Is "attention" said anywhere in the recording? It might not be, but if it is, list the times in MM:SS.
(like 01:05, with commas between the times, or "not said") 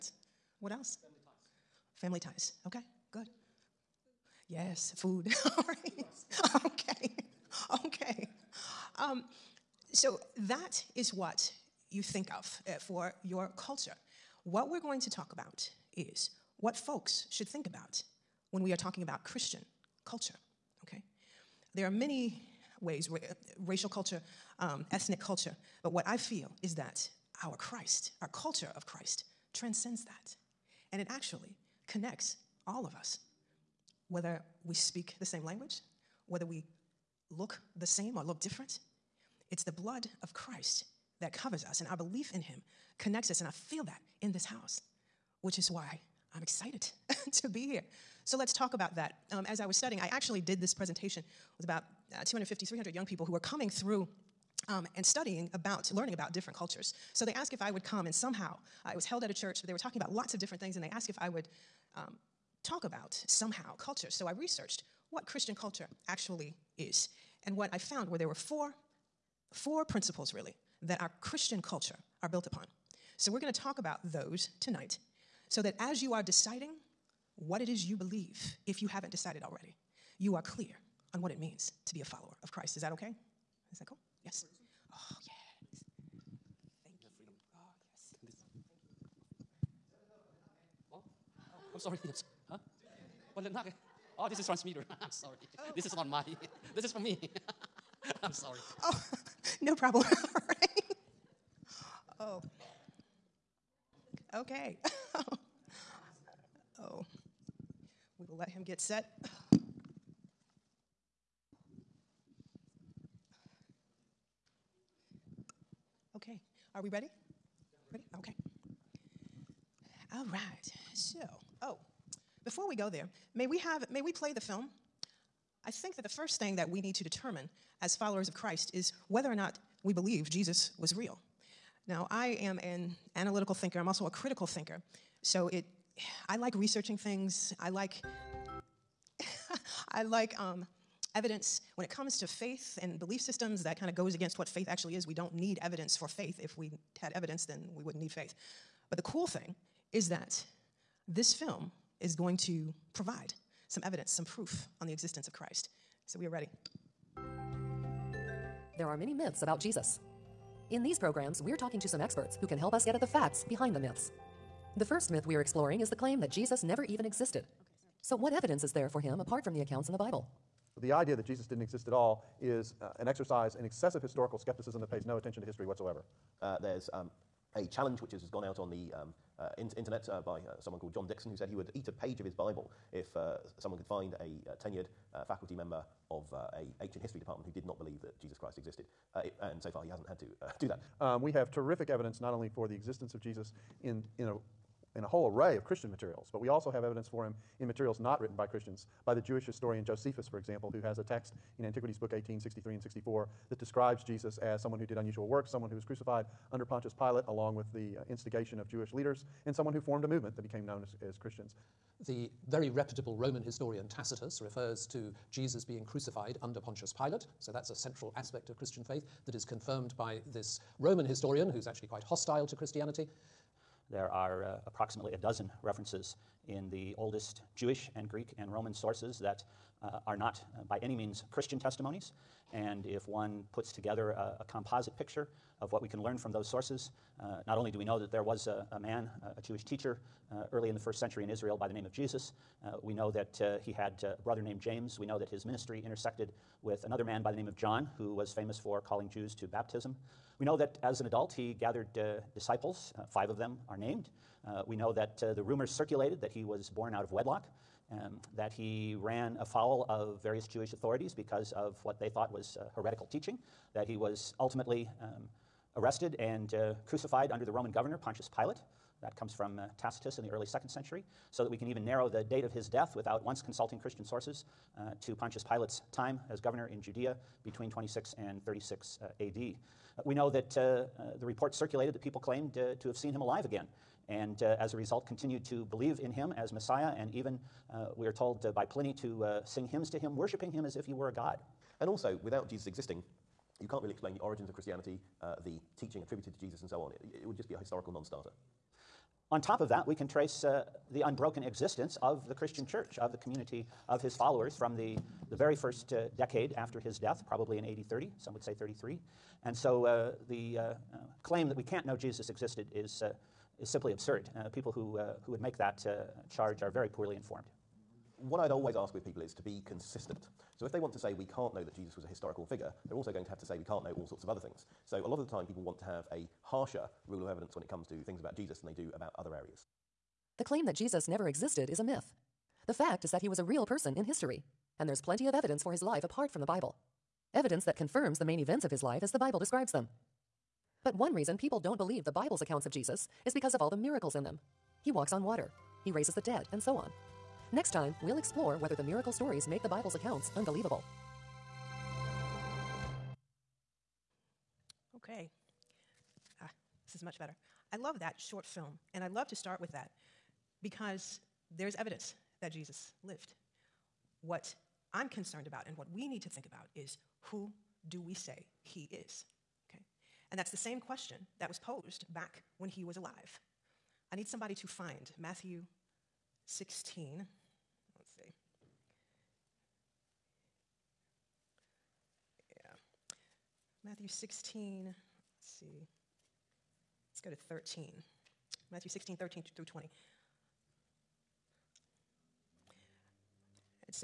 02:55.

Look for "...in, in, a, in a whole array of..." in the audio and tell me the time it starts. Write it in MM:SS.
03:13.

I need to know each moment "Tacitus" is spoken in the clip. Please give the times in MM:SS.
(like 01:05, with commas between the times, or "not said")
03:33, 04:29.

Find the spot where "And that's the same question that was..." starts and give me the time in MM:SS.
06:10.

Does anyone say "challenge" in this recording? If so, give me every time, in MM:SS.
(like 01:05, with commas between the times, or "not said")
02:57.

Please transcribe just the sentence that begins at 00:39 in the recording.
It's the blood of Christ that covers us, and our belief in Him connects us.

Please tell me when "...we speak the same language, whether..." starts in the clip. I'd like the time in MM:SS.
00:34.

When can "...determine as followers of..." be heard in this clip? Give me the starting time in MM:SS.
02:07.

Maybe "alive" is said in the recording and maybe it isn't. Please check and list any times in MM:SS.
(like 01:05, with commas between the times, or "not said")
04:43, 06:12.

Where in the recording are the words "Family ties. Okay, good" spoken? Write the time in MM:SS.
00:02.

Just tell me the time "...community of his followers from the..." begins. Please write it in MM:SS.
05:03.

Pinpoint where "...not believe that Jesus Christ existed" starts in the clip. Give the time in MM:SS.
03:07.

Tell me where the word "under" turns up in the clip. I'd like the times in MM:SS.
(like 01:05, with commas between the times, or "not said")
03:26, 03:36, 04:27.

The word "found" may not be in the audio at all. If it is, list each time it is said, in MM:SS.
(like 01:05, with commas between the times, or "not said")
01:07.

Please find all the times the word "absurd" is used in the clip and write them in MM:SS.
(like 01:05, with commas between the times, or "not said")
05:13.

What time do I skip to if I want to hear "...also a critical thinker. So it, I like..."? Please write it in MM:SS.
02:13.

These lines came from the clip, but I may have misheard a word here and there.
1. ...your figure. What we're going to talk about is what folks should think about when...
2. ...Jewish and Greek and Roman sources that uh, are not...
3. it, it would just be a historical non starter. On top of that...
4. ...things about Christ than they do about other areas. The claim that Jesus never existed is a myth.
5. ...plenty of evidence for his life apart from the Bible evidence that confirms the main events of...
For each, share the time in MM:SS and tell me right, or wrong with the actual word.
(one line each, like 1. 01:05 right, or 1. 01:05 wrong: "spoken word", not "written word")
1. 00:13 wrong: "culture", not "figure"
2. 03:47 right
3. 04:56 right
4. 05:28 wrong: "Jesus", not "Christ"
5. 05:34 right.